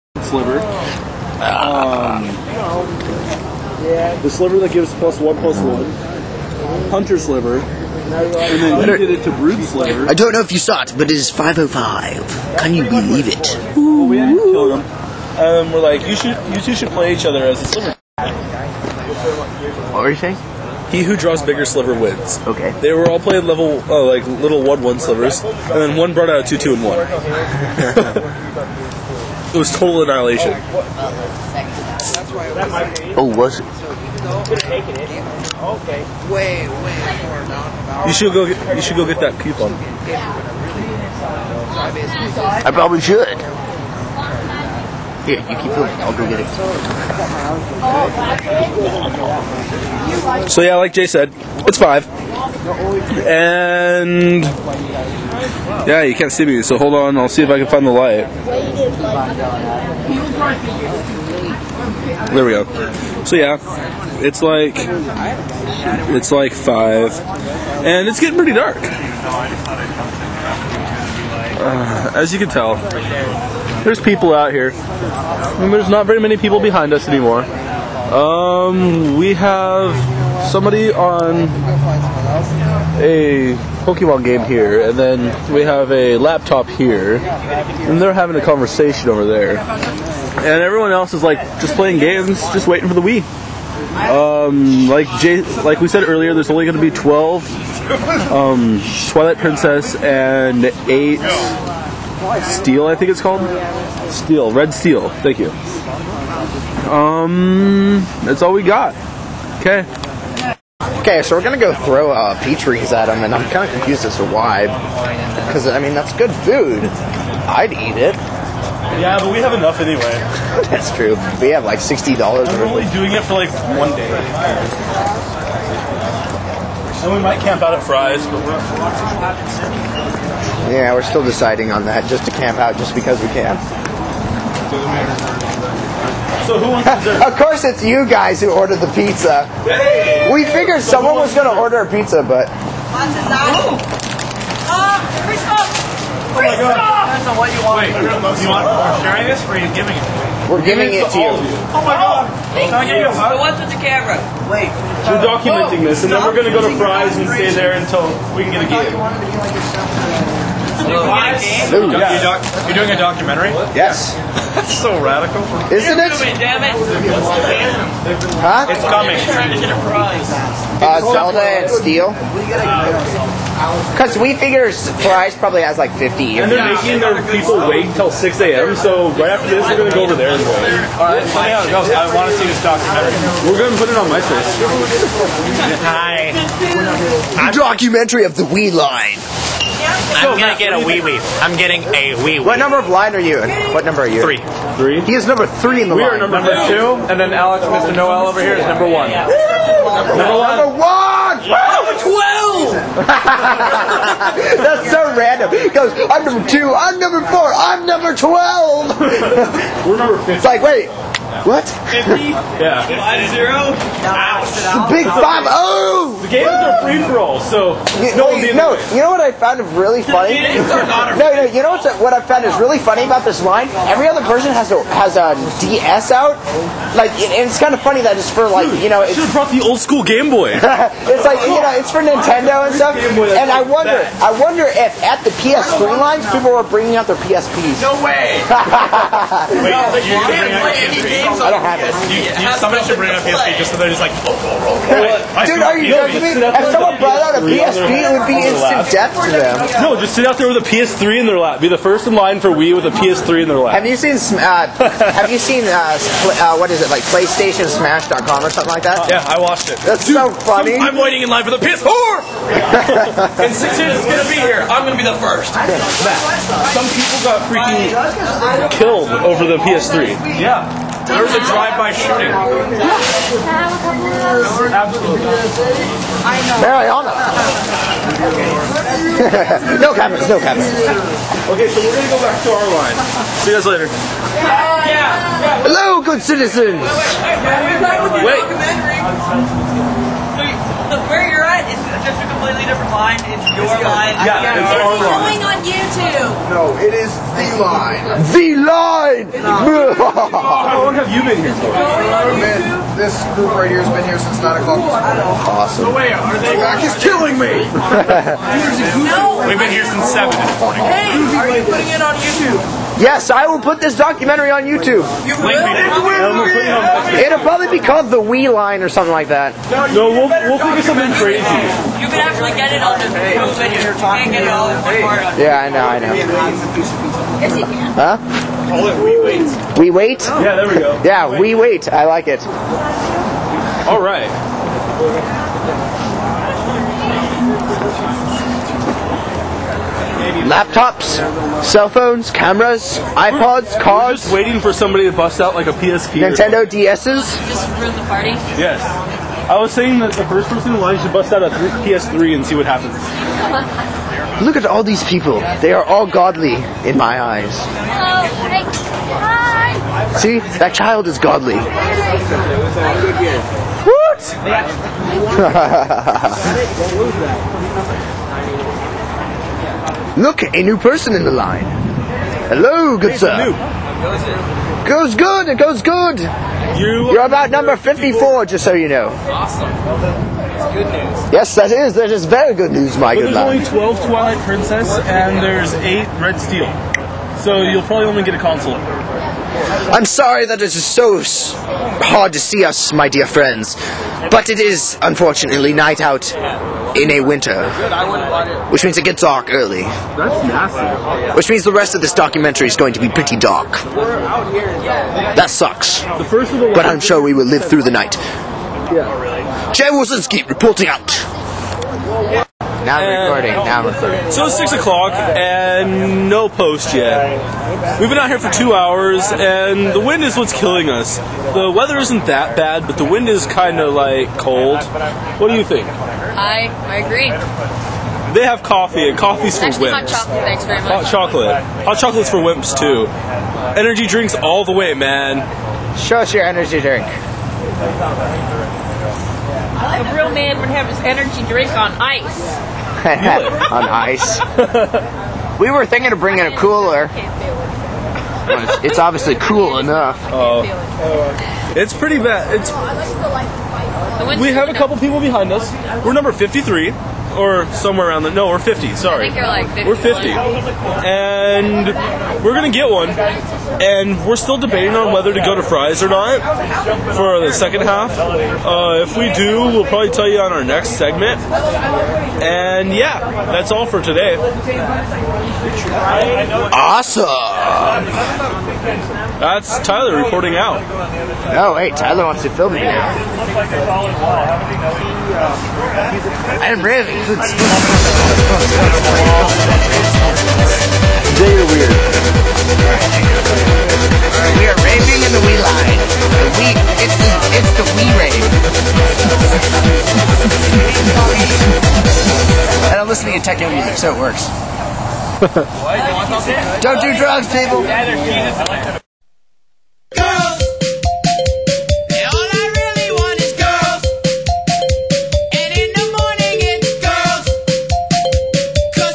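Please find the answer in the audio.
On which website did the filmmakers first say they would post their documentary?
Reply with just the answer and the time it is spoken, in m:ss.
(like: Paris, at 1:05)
MySpace, at 3:04.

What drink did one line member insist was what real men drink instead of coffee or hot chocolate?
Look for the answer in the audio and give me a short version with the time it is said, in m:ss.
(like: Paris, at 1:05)
Energy drinks, at 7:13.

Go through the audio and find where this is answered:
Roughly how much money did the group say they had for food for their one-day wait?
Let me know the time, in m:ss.
2:01.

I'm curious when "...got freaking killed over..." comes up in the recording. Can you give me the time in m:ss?
4:27.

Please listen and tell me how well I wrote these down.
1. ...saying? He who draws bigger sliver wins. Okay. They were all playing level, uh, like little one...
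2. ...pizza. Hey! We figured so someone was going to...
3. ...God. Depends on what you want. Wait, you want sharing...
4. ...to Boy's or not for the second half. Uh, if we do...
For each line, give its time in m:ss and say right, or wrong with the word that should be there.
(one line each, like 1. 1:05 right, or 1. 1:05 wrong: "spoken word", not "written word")
1. 0:20 right
2. 2:18 right
3. 2:26 right
4. 7:45 wrong: "Fry", not "Boy".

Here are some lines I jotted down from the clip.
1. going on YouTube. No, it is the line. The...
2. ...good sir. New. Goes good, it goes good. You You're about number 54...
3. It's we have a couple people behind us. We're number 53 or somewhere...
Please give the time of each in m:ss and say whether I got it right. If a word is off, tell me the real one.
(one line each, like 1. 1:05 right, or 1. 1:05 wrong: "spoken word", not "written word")
1. 4:55 right
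2. 6:12 right
3. 7:32 right.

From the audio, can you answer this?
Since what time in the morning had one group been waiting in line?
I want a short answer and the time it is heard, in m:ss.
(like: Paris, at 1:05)
7, at 5:10.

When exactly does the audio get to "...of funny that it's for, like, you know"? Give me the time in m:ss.
3:47.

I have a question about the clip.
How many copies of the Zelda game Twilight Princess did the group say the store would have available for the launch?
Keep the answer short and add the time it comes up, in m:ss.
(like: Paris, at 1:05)
12, at 1:36.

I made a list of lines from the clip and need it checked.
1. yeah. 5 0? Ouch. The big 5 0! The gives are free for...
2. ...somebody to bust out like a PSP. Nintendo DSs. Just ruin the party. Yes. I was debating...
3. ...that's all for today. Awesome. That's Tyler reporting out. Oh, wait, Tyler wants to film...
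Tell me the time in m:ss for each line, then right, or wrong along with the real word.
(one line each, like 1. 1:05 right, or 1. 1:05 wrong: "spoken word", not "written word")
1. 3:32 wrong: "games", not "gives"
2. 5:44 wrong: "saying", not "debating"
3. 7:53 right.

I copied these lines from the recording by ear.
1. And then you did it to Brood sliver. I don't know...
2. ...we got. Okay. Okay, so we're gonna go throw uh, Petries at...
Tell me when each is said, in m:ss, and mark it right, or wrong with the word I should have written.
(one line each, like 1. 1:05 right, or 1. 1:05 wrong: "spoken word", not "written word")
1. 0:07 right
2. 1:48 right.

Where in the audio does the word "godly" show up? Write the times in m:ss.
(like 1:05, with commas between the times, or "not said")
5:56, 6:01.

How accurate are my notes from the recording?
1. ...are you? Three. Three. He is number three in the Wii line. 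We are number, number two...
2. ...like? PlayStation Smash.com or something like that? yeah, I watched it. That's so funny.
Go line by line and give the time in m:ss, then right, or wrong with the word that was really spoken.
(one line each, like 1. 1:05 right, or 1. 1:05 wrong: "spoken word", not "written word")
1. 3:14 right
2. 4:16 right.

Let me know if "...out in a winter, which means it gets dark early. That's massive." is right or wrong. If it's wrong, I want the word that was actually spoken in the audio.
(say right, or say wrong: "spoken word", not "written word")
right.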